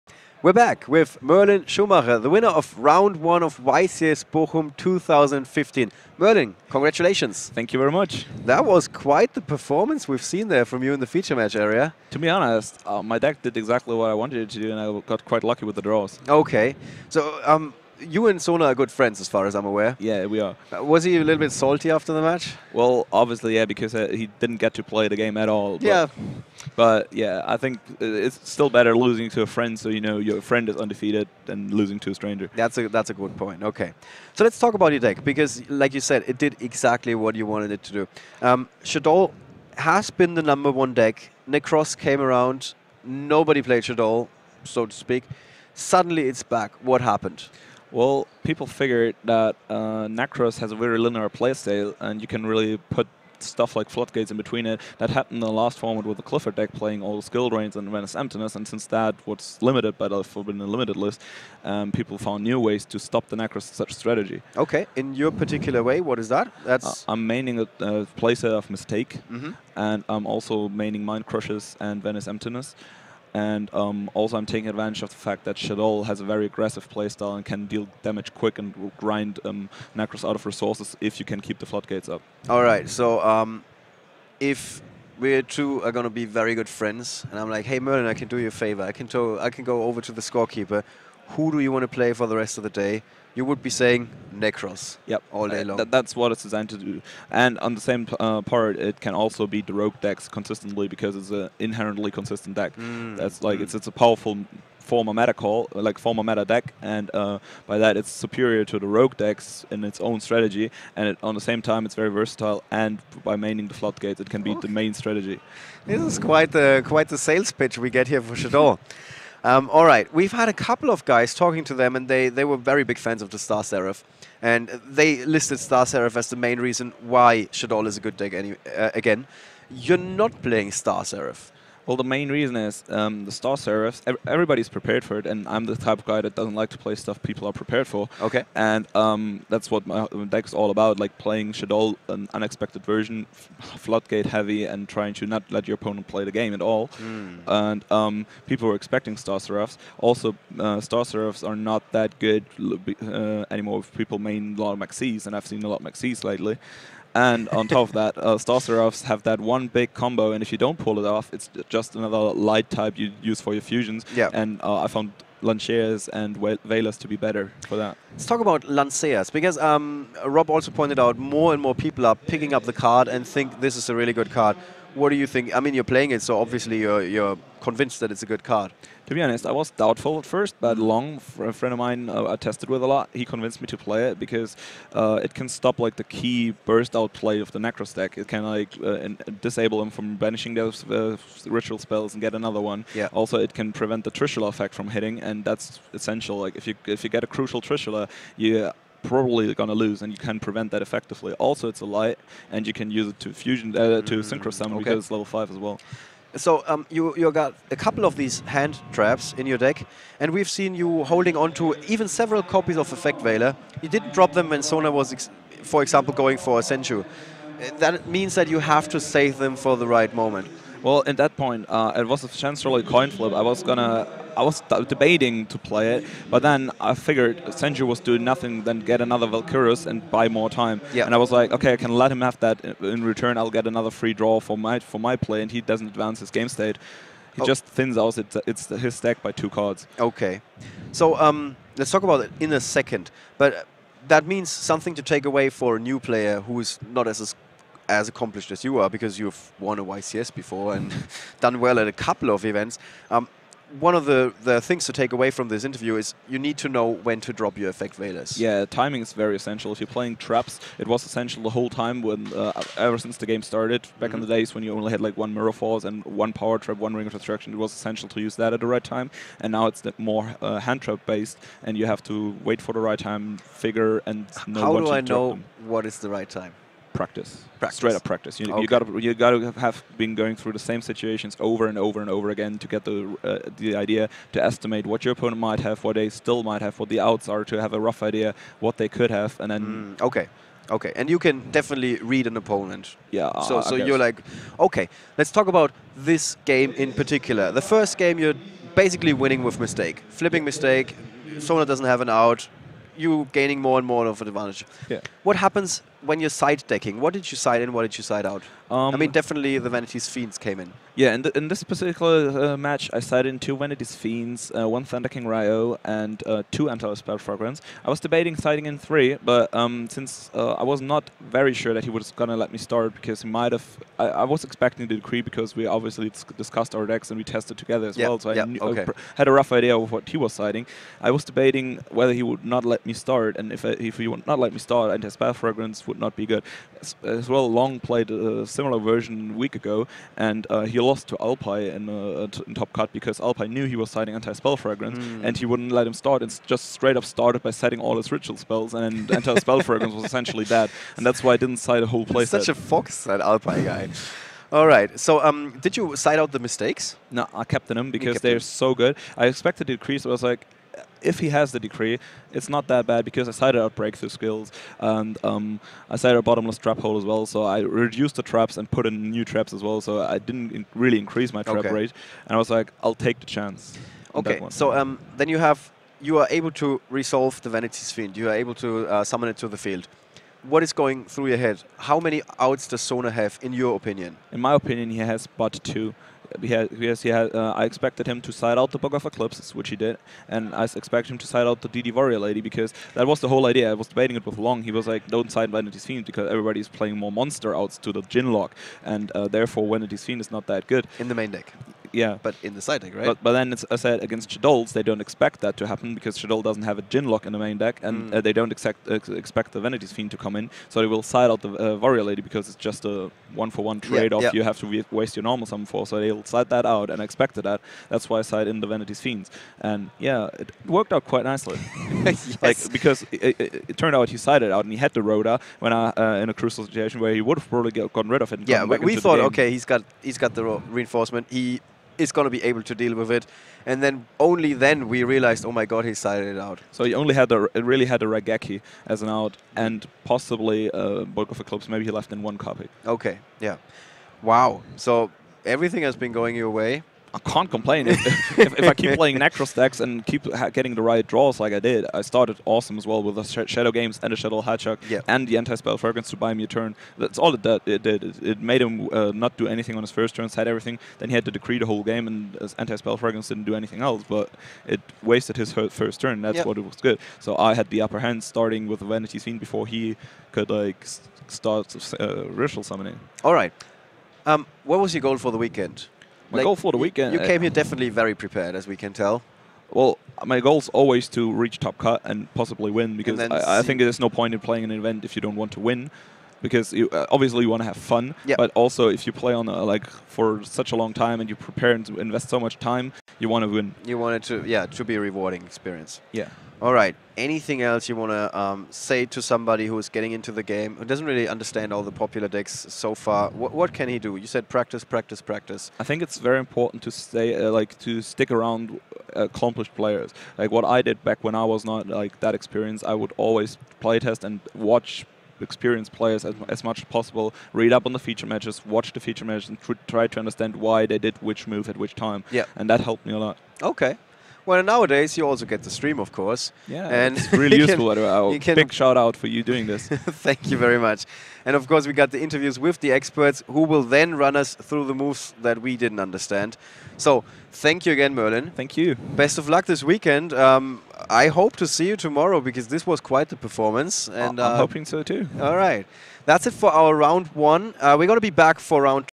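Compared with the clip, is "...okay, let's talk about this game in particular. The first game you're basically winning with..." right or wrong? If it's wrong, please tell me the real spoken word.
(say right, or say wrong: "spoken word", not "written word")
right.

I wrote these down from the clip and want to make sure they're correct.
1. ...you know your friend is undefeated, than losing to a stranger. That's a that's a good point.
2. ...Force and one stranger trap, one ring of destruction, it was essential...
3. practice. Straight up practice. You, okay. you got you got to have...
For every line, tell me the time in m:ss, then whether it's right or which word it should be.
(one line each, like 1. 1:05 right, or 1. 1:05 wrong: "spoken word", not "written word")
1. 0:29 right
2. 4:25 wrong: "power", not "stranger"
3. 4:37 right.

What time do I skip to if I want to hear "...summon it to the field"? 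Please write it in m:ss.
6:19.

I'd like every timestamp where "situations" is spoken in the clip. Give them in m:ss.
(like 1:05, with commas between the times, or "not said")
4:40, 7:06.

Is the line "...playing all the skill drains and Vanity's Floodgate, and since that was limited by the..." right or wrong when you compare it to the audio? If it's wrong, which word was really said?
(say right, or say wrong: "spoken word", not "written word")
wrong: "Emptiness", not "Floodgate".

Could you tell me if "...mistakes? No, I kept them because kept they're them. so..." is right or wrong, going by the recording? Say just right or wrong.
right.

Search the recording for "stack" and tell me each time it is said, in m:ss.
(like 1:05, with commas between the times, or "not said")
3:07, 3:58, 7:29.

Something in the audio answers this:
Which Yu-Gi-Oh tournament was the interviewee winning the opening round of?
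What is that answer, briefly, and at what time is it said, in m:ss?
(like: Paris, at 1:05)
YCS Bochum 2015, at 0:03.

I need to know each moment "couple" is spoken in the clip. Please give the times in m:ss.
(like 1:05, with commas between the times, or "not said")
2:00, 3:27, 4:11.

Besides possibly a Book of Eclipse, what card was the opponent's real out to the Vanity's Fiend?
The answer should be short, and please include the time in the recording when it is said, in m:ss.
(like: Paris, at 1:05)
Raigeki, at 7:18.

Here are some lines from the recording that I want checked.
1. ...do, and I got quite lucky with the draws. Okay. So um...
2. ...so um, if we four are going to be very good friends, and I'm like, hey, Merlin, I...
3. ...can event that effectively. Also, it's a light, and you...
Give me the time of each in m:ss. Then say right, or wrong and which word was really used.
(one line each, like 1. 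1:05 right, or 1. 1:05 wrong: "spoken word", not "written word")
1. 0:14 right
2. 1:22 wrong: "two", not "four"
3. 3:20 wrong: "prevent", not "event".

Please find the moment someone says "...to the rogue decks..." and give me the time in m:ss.
1:48.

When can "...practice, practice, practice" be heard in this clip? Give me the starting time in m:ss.
8:24.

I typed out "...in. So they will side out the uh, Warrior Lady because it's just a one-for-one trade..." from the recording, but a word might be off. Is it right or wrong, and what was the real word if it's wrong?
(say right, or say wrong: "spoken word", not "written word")
right.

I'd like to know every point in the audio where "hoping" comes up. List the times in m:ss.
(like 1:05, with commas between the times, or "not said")
9:04.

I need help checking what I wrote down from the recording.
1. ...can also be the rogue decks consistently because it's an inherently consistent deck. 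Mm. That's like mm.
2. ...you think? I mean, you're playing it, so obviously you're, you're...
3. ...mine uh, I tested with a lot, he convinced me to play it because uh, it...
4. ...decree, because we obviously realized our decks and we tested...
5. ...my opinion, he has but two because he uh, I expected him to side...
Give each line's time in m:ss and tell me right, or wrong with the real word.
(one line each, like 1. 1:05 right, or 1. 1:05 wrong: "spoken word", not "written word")
1. 1:39 right
2. 2:55 right
3. 3:01 right
4. 5:24 wrong: "discussed", not "realized"
5. 6:24 right.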